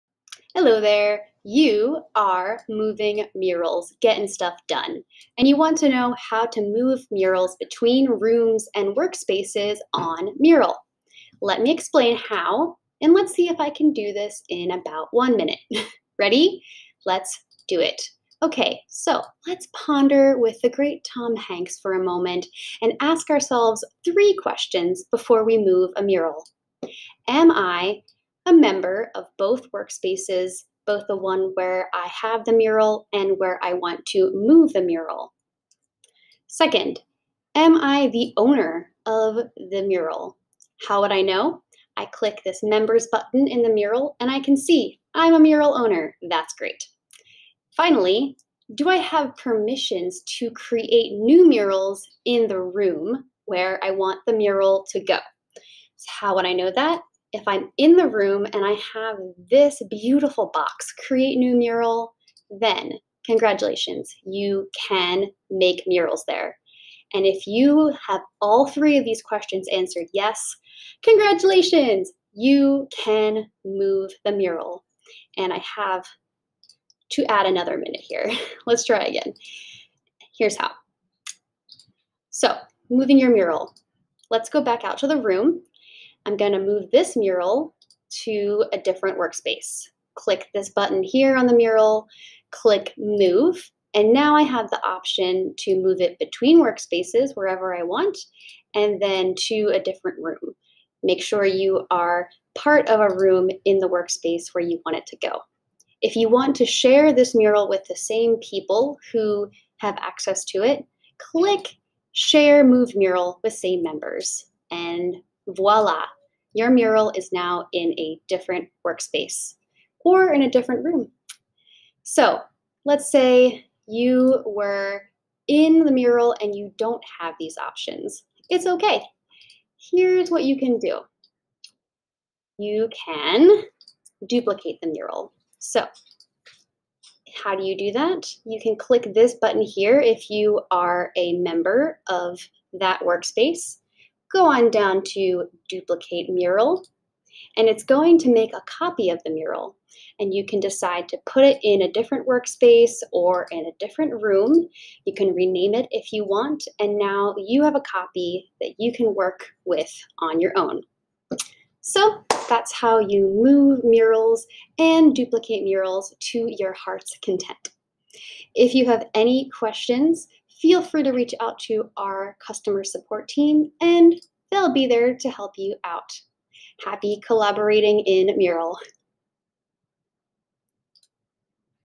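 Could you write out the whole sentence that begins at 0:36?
Second, am I the owner of the mural?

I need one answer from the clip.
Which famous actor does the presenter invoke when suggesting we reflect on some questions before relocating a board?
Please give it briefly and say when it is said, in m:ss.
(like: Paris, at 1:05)
Tom Hanks, at 0:21.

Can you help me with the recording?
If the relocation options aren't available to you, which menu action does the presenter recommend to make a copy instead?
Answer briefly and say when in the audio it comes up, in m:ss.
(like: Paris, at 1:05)
duplicate mural, at 2:25.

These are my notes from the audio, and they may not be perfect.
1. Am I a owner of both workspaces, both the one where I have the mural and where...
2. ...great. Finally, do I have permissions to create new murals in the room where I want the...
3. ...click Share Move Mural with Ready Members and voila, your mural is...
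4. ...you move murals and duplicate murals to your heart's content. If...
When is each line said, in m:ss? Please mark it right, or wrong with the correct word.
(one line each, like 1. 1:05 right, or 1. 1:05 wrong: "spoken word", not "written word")
1. 0:27 wrong: "member", not "owner"
2. 0:46 right
3. 1:51 wrong: "Same", not "Ready"
4. 2:42 right.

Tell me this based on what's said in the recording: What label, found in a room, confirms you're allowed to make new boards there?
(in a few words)
create new mural.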